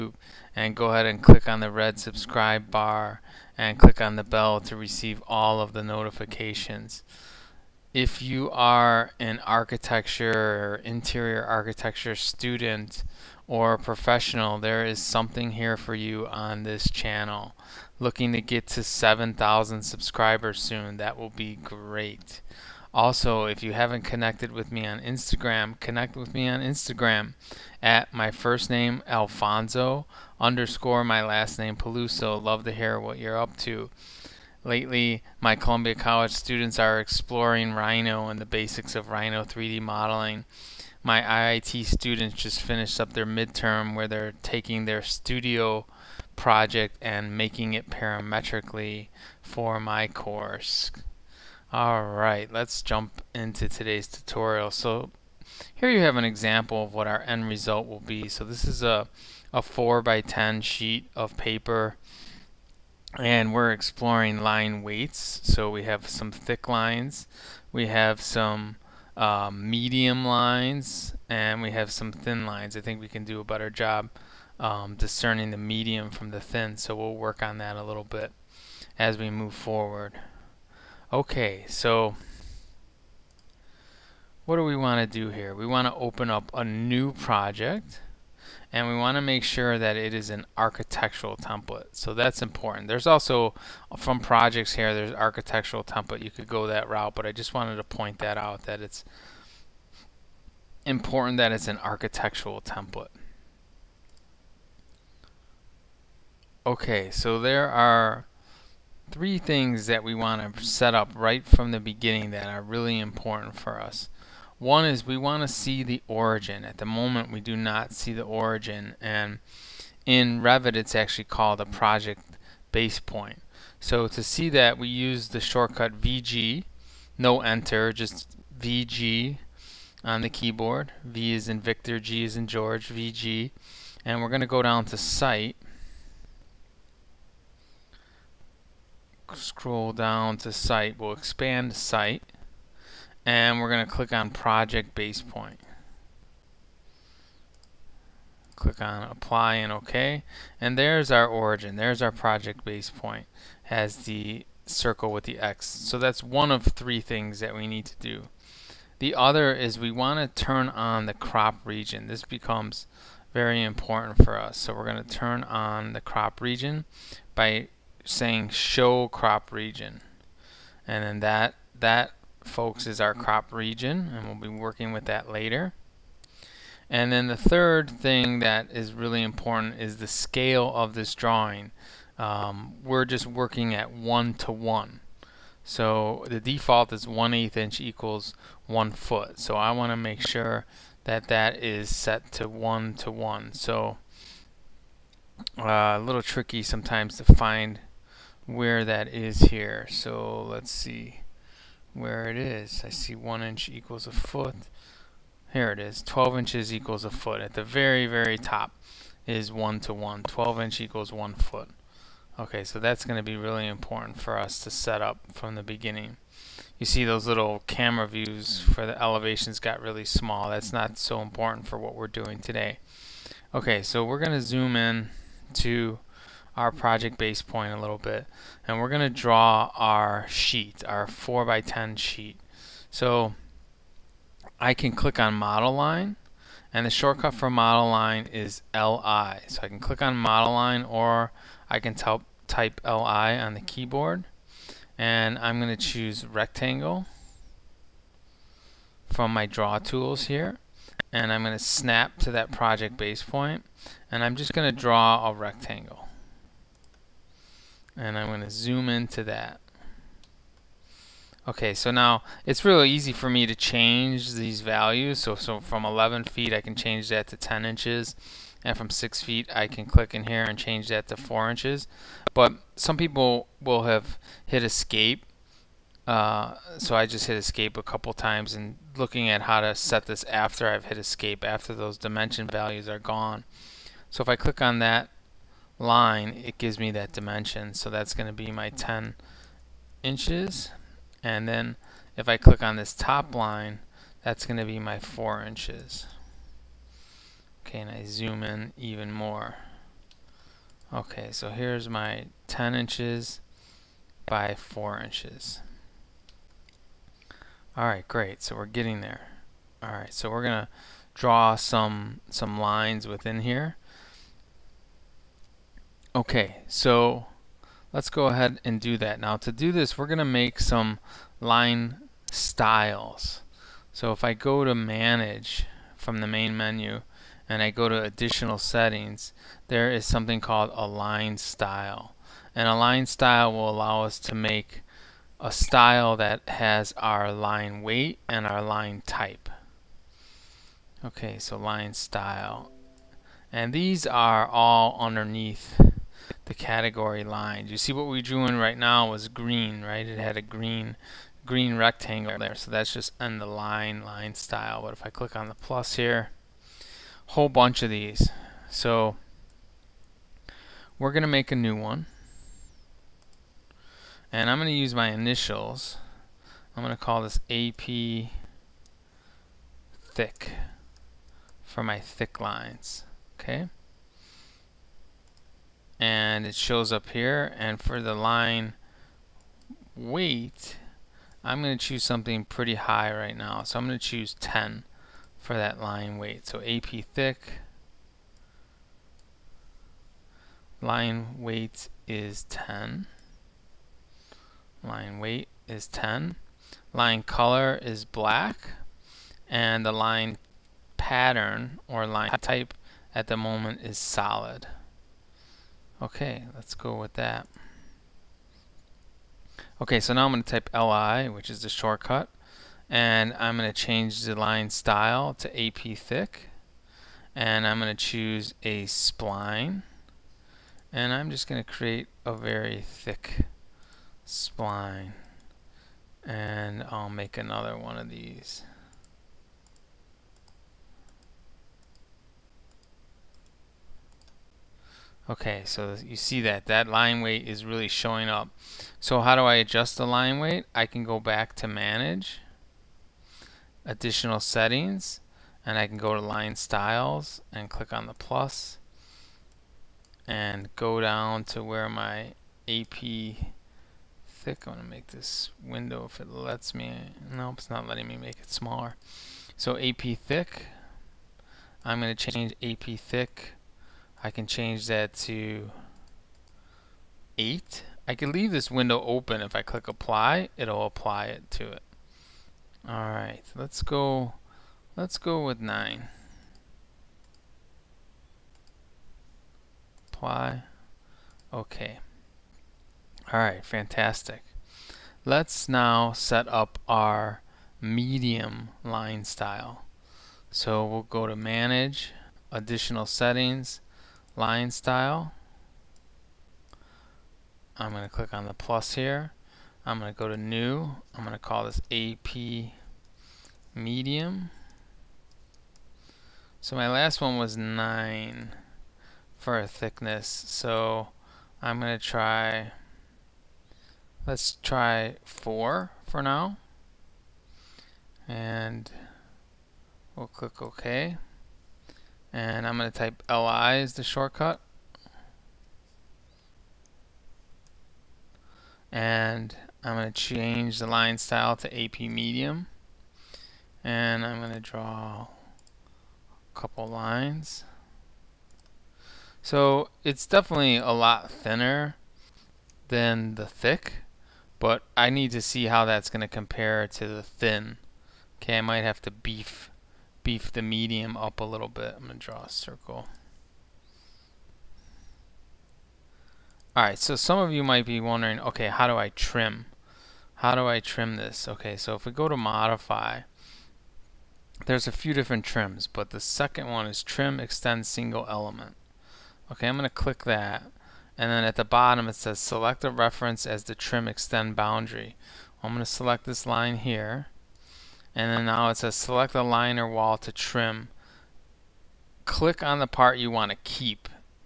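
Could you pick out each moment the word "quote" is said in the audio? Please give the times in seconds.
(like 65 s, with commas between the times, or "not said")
not said.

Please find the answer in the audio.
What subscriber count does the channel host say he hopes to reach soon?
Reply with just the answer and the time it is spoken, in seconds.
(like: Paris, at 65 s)
7,000, at 18 s.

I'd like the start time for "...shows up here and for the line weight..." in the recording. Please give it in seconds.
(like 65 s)
376 s.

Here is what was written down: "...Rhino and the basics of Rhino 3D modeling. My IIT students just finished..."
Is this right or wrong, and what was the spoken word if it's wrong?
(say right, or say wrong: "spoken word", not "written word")
right.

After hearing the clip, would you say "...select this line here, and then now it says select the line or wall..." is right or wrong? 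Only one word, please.
right.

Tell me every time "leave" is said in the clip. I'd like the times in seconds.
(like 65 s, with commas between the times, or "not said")
468 s.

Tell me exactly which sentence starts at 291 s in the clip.
And then if I click on this top line, that's going to be my 4 inches.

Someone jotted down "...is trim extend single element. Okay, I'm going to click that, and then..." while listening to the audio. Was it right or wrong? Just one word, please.
right.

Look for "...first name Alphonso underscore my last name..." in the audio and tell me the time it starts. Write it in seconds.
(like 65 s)
28 s.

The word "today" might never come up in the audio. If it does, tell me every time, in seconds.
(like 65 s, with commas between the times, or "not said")
53 s, 222 s.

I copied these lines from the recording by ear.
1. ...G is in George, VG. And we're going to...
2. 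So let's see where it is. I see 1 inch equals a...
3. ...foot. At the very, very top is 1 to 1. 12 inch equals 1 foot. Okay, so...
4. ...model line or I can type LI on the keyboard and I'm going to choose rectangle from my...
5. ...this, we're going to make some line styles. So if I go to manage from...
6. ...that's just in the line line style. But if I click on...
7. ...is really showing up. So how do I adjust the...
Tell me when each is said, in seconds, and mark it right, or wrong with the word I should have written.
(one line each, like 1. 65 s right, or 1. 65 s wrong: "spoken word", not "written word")
1. 131 s right
2. 199 s right
3. 207 s right
4. 240 s right
5. 319 s right
6. 352 s right
7. 437 s right.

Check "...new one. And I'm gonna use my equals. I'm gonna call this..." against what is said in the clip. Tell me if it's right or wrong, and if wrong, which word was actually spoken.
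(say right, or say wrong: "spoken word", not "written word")
wrong: "initials", not "equals".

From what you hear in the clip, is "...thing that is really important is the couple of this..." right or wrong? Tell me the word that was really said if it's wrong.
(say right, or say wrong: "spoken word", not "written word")
wrong: "scale", not "couple".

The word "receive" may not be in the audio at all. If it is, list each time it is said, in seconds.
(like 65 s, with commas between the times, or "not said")
4 s.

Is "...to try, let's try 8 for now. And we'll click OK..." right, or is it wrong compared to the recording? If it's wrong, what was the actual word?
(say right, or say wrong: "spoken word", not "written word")
wrong: "4", not "8".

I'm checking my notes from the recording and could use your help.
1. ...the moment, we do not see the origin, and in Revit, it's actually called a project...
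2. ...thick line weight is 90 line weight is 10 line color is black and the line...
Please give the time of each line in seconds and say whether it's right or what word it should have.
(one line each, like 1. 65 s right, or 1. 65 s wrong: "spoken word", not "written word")
1. 116 s right
2. 387 s wrong: "10", not "90".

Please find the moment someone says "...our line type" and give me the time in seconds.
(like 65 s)
338 s.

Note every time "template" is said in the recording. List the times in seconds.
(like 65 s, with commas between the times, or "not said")
91 s, 95 s, 102 s.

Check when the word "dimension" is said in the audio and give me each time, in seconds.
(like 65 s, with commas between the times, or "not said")
281 s, 287 s.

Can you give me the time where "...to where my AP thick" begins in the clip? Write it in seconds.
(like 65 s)
451 s.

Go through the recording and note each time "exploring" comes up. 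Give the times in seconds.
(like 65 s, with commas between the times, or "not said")
36 s, 63 s.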